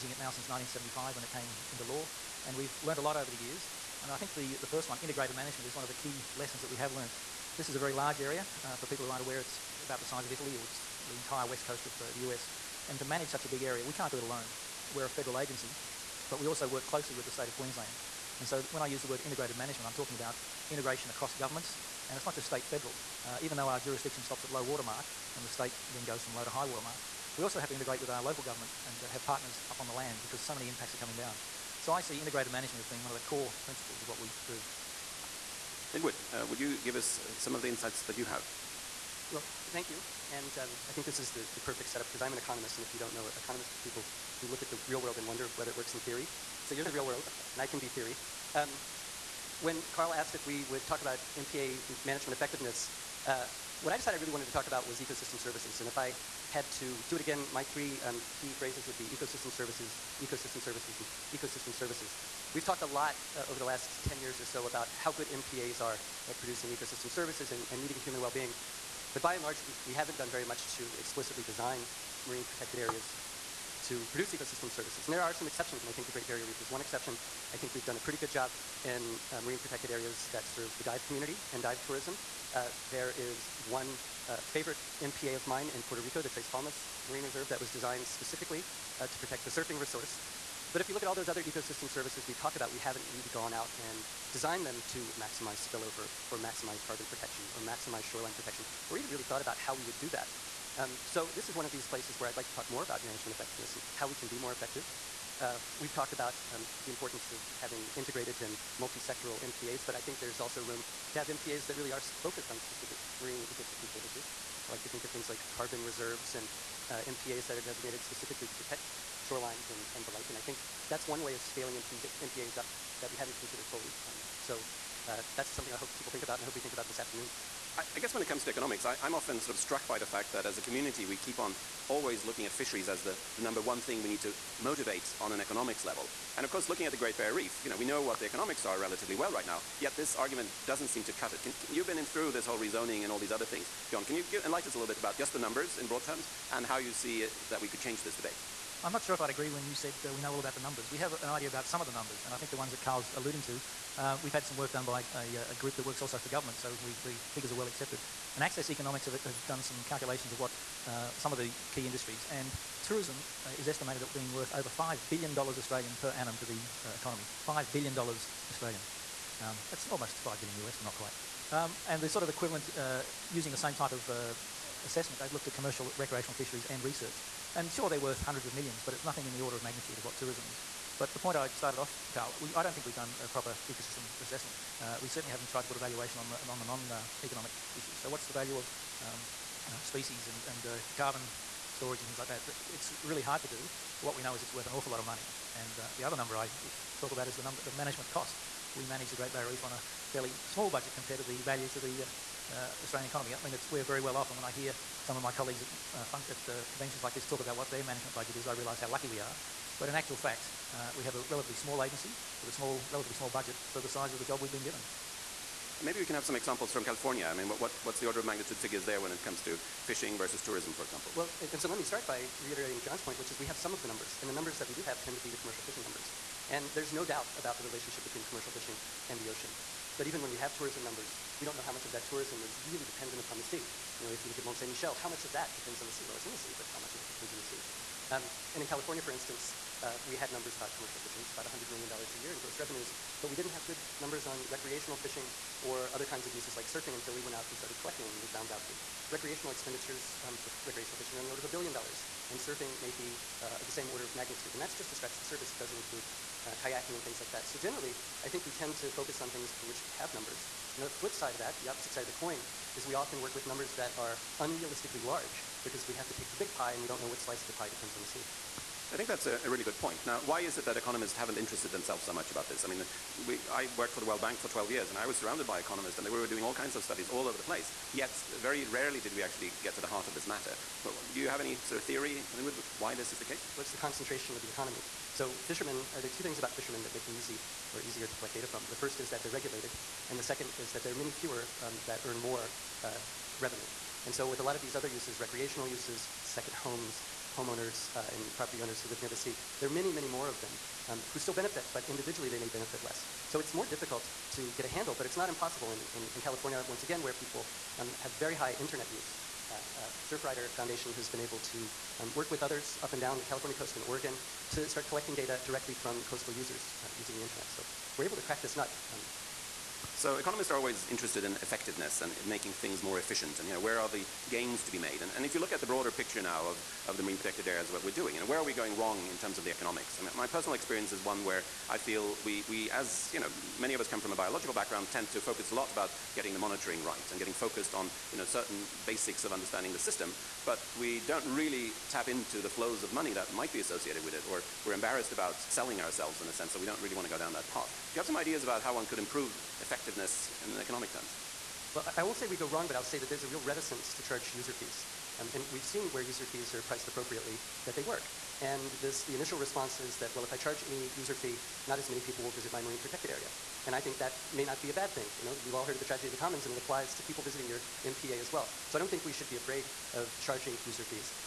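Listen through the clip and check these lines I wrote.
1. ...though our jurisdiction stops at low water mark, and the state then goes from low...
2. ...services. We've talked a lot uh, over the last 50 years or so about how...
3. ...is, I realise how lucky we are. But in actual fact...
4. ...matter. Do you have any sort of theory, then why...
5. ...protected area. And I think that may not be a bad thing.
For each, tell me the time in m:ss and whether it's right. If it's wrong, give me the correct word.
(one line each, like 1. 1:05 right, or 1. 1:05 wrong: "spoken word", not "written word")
1. 0:23 right
2. 1:01 wrong: "10", not "50"
3. 3:28 right
4. 4:40 right
5. 6:02 right.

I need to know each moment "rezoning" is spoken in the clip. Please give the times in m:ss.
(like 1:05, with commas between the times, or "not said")
2:22.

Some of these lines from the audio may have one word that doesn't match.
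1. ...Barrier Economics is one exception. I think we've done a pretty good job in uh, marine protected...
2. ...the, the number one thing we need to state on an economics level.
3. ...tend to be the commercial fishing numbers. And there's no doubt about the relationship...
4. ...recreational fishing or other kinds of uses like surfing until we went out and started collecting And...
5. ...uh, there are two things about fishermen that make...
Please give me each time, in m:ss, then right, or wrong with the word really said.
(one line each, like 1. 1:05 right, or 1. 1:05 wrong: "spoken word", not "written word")
1. 1:16 wrong: "Reef", not "Economics"
2. 2:13 wrong: "motivate", not "state"
3. 3:45 right
4. 4:04 right
5. 4:45 right.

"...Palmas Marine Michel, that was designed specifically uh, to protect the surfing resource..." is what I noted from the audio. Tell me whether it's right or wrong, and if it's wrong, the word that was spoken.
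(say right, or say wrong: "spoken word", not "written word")
wrong: "Reserve", not "Michel".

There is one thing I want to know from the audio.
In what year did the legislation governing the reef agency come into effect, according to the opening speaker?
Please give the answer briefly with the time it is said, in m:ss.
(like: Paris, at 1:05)
1975, at 0:00.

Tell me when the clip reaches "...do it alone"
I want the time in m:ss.
0:14.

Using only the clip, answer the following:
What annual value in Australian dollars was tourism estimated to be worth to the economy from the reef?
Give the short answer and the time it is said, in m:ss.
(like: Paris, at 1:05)
Over $5 billion, at 2:44.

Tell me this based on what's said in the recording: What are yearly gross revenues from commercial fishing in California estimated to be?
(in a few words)
$100 million.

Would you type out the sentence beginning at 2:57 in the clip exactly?
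And sure, they're worth hundreds of millions, but it's nothing in the order of magnitude of what tourism is.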